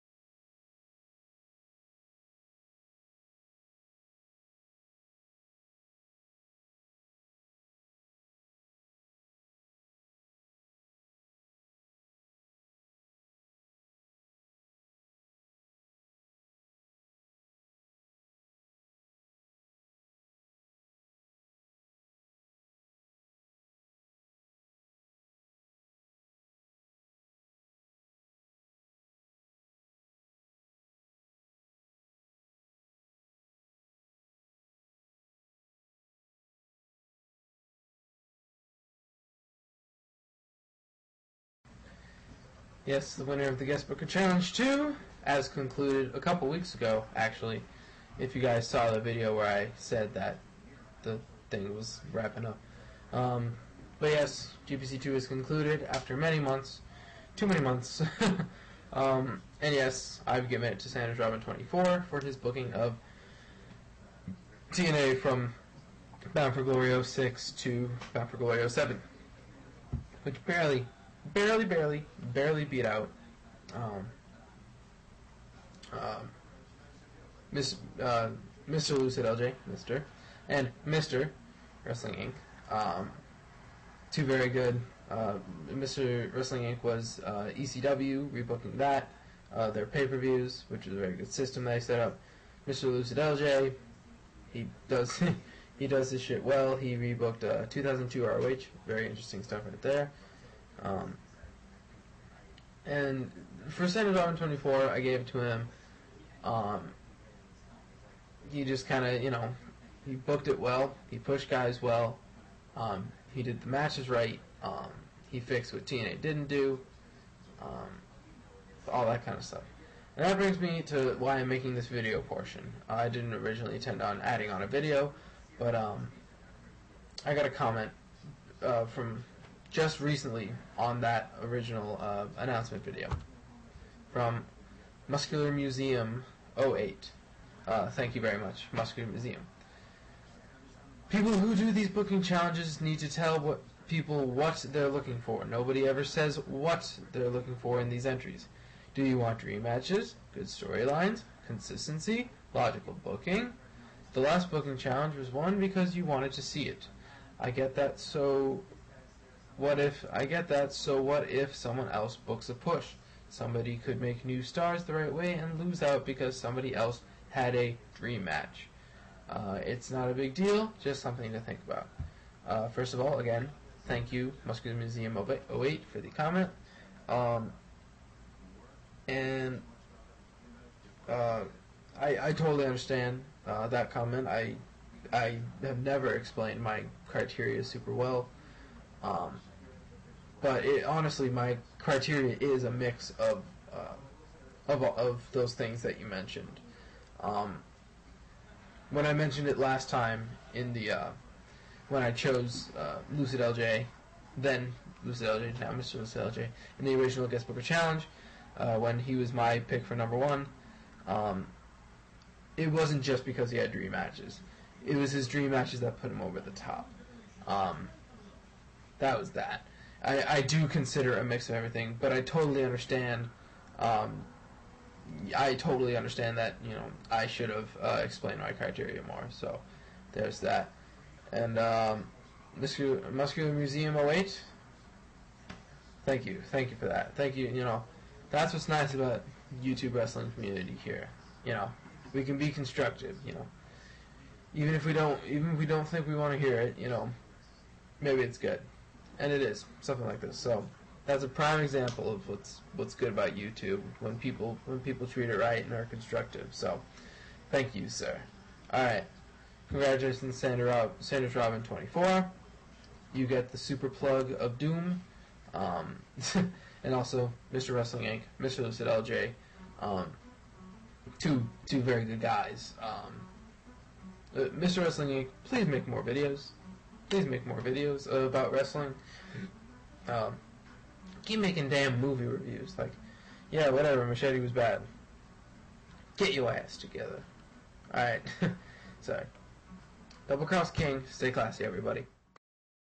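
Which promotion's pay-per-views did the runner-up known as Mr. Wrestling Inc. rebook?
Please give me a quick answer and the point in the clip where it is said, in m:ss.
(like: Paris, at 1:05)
ECW, at 1:27.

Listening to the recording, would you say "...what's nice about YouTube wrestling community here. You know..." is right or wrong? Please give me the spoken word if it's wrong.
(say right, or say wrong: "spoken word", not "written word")
right.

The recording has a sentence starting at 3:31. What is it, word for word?
Um, it wasn't just because he had dream matches.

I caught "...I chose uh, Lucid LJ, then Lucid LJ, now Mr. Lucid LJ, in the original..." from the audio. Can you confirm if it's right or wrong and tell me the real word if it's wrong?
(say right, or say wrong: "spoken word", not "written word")
right.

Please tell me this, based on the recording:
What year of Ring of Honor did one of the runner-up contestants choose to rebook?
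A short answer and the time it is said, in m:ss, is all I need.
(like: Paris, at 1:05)
2002, at 1:37.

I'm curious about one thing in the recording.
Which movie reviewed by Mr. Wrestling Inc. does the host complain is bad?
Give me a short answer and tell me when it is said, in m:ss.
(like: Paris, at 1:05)
Machete, at 4:44.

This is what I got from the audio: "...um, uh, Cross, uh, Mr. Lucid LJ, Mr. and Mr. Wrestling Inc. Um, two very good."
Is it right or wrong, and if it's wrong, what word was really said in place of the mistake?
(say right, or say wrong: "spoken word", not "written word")
wrong: "Miss", not "Cross".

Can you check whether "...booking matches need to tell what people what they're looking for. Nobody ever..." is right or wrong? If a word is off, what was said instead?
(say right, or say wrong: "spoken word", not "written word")
wrong: "challenges", not "matches".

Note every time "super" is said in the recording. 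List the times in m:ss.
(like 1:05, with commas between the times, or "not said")
3:07, 4:23.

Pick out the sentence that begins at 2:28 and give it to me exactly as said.
Do you want dream matches, good storylines, consistency, logical booking?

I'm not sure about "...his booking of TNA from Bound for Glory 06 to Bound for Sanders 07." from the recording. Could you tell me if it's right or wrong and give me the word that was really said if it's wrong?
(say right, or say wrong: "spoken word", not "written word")
wrong: "Glory", not "Sanders".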